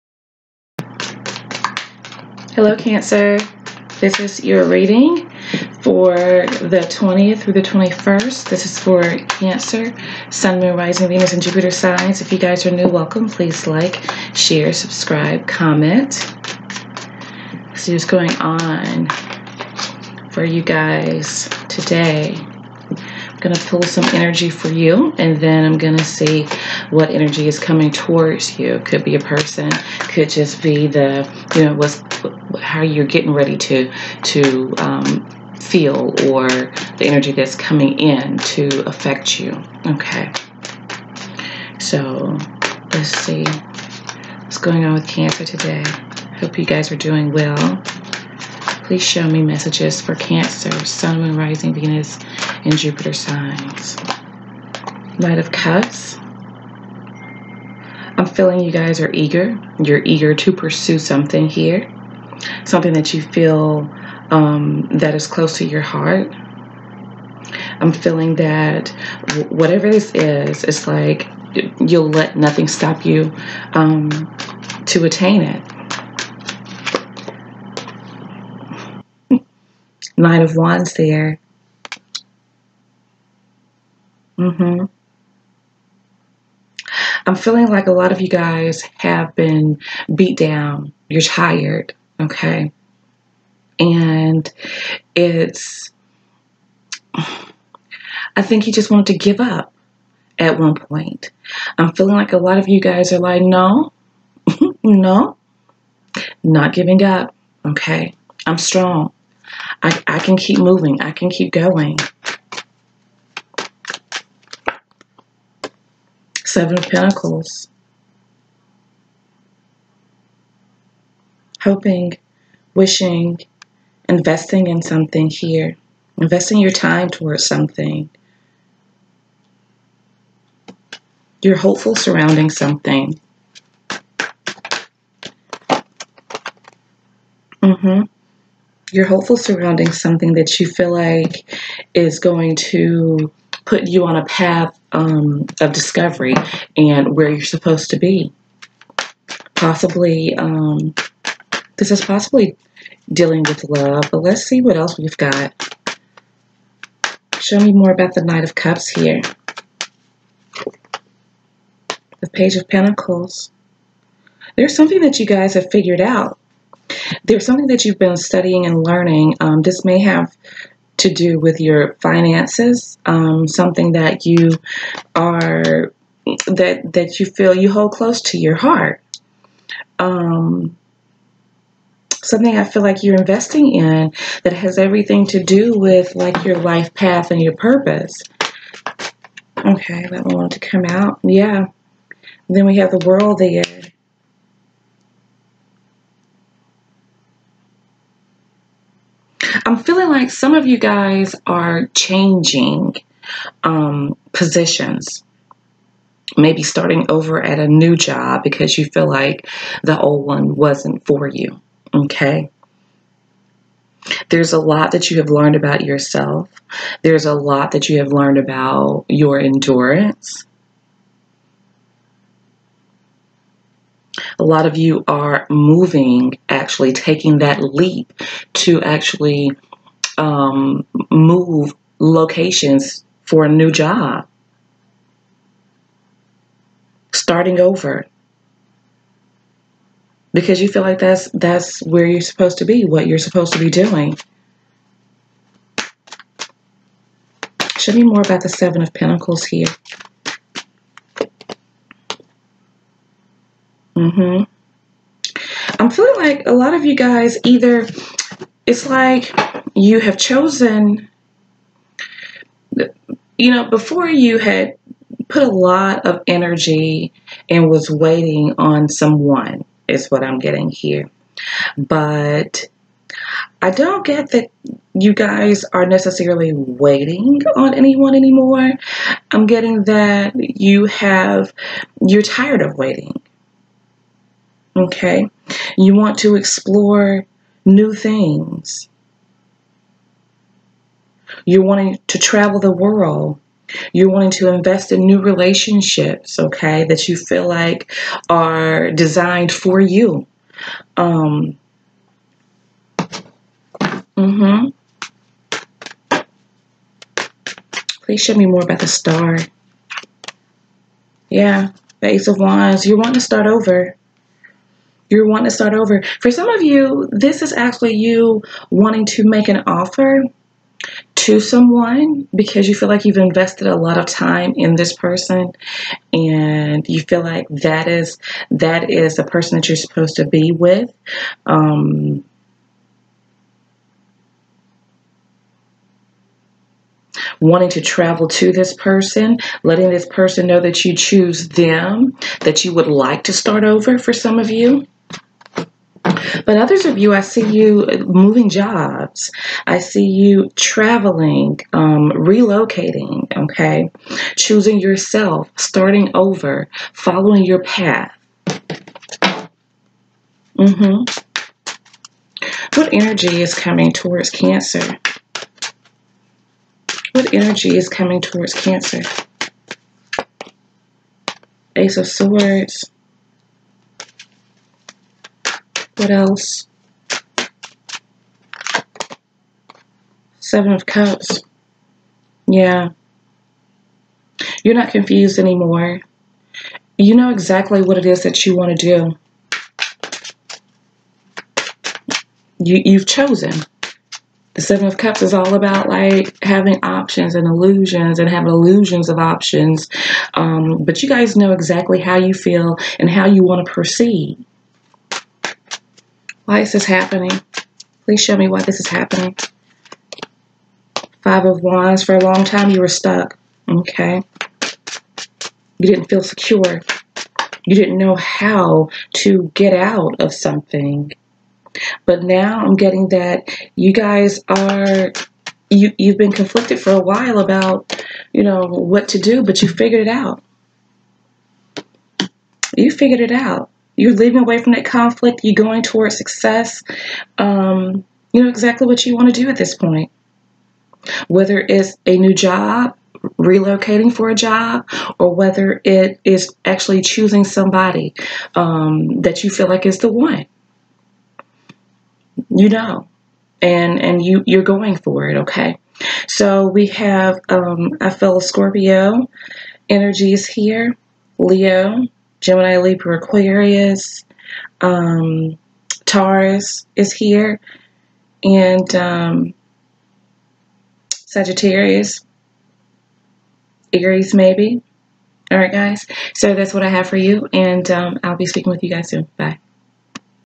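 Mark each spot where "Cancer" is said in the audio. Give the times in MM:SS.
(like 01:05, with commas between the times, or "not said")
00:02, 00:09, 00:45, 00:50, 06:04, 06:08.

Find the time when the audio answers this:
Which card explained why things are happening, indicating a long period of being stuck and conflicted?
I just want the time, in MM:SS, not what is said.
06:51.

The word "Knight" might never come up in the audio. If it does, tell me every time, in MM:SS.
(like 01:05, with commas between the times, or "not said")
00:55, 02:38.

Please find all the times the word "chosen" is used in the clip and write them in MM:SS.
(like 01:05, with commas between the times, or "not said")
04:20, 06:33.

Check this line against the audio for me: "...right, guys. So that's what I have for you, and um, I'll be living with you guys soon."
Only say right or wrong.
wrong.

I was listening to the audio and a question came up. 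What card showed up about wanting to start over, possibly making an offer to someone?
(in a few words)
Ace of Wands.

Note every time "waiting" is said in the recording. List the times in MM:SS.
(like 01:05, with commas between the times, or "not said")
04:27, 04:36, 04:42.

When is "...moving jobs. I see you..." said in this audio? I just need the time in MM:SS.
05:48.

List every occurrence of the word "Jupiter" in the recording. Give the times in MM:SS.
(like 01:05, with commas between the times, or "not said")
00:11, 00:52.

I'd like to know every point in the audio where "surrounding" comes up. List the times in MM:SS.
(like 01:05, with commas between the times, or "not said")
02:11, 02:19.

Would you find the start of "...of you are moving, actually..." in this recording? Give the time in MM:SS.
03:44.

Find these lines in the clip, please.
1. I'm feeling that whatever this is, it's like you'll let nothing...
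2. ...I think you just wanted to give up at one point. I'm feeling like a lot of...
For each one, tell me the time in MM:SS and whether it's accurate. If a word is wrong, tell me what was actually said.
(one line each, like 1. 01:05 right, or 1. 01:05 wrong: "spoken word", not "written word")
1. 01:07 right
2. 01:37 right.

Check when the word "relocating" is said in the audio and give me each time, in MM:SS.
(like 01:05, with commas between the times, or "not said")
05:52, 07:23.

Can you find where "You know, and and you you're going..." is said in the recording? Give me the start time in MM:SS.
07:32.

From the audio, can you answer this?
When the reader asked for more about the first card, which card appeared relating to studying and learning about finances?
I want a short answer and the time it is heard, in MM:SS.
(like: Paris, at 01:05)
Page of Pentacles, at 02:42.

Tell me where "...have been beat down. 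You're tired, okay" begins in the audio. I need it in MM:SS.
01:28.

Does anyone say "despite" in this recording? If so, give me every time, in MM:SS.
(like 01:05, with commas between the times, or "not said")
not said.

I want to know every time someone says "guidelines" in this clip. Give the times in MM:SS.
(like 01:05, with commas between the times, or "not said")
not said.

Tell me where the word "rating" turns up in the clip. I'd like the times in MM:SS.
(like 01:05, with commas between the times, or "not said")
not said.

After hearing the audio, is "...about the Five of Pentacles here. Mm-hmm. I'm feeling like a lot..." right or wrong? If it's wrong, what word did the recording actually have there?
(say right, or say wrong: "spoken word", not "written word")
wrong: "Seven", not "Five".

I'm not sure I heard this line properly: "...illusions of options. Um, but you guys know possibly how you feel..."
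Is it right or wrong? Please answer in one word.
wrong.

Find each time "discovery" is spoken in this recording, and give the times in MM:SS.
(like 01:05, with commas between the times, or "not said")
02:25.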